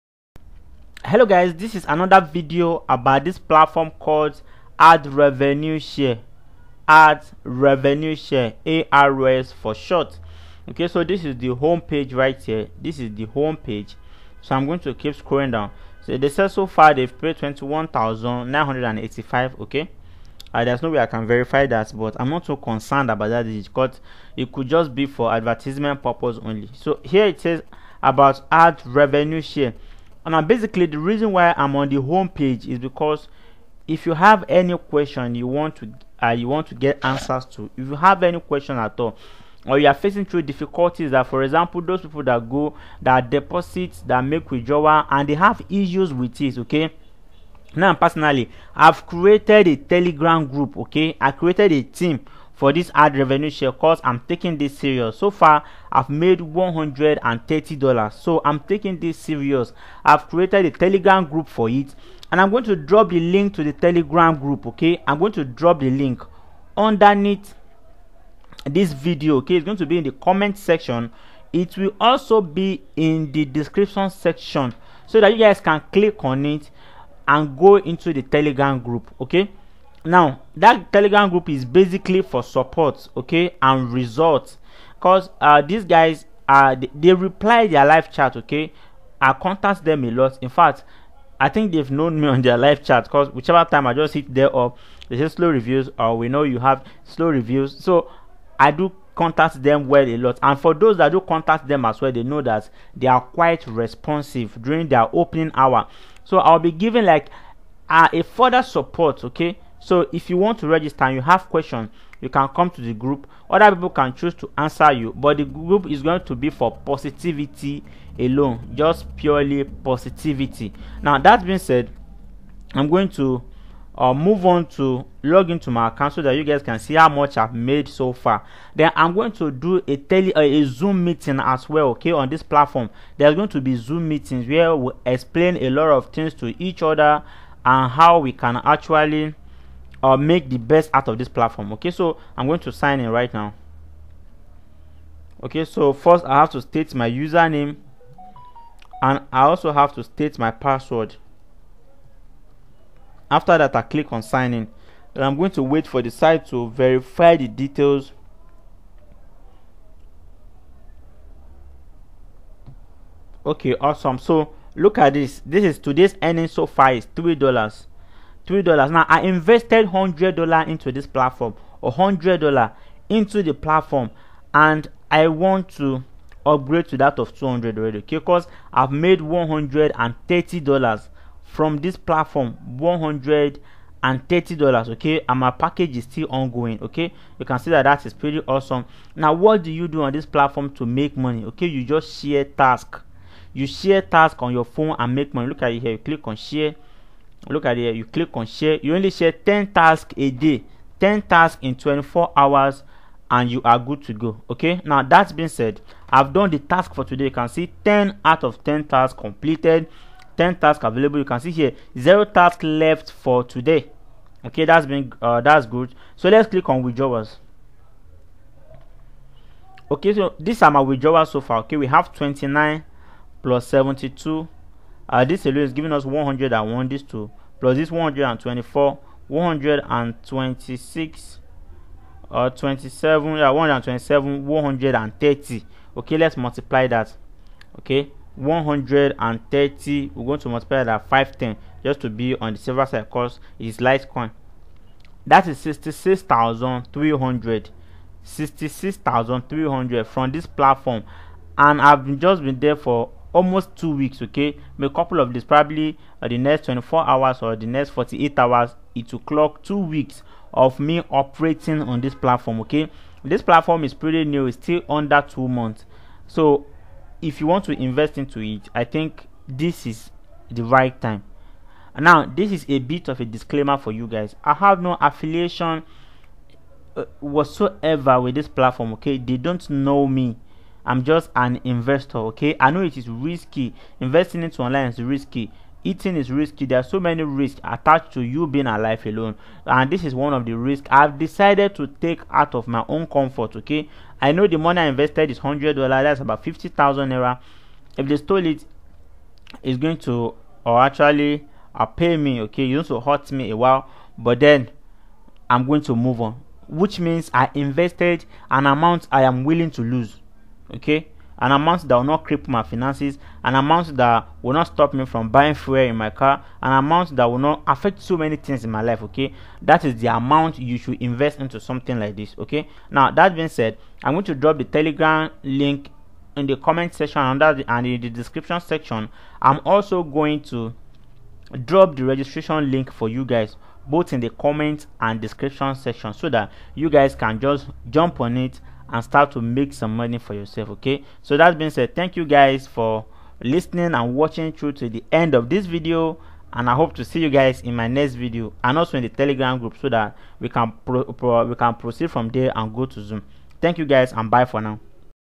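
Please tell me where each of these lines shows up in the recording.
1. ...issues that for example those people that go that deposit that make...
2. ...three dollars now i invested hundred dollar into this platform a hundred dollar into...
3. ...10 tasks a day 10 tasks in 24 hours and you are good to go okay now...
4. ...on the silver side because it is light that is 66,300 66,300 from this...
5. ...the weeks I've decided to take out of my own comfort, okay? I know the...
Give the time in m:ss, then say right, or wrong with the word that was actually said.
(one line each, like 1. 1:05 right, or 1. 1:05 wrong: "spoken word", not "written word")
1. 0:40 wrong: "difficulties", not "issues"
2. 2:48 right
3. 3:19 right
4. 4:02 right
5. 4:50 wrong: "risks", not "weeks".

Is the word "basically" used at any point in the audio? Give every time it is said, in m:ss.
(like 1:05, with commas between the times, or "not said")
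0:30, 1:21.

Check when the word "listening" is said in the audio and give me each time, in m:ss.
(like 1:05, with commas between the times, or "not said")
5:43.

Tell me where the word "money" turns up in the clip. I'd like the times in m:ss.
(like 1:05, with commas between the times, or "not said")
3:11, 3:15, 4:54, 5:39.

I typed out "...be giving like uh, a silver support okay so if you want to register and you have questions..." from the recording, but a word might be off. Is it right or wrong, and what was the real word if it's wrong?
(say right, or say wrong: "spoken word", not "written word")
wrong: "further", not "silver".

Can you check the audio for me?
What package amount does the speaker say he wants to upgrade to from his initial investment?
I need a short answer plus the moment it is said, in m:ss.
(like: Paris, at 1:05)
200, at 2:57.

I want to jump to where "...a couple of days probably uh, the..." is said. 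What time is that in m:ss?
4:14.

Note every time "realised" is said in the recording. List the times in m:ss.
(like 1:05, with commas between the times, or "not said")
not said.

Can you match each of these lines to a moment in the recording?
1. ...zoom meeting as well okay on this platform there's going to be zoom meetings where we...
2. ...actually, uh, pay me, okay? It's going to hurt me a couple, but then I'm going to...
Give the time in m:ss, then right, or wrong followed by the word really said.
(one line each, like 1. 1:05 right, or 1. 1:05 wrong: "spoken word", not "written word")
1. 2:10 right
2. 5:00 wrong: "while", not "couple".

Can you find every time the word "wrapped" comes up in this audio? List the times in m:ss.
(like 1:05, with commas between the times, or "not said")
not said.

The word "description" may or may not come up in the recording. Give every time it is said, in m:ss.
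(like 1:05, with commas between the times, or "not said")
1:13, 5:28, 5:35.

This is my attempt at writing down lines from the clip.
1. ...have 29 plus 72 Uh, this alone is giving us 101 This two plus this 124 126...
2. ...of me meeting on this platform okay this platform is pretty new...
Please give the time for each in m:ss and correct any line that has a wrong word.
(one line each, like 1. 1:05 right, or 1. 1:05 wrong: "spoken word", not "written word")
1. 3:41 right
2. 4:20 wrong: "operating", not "meeting".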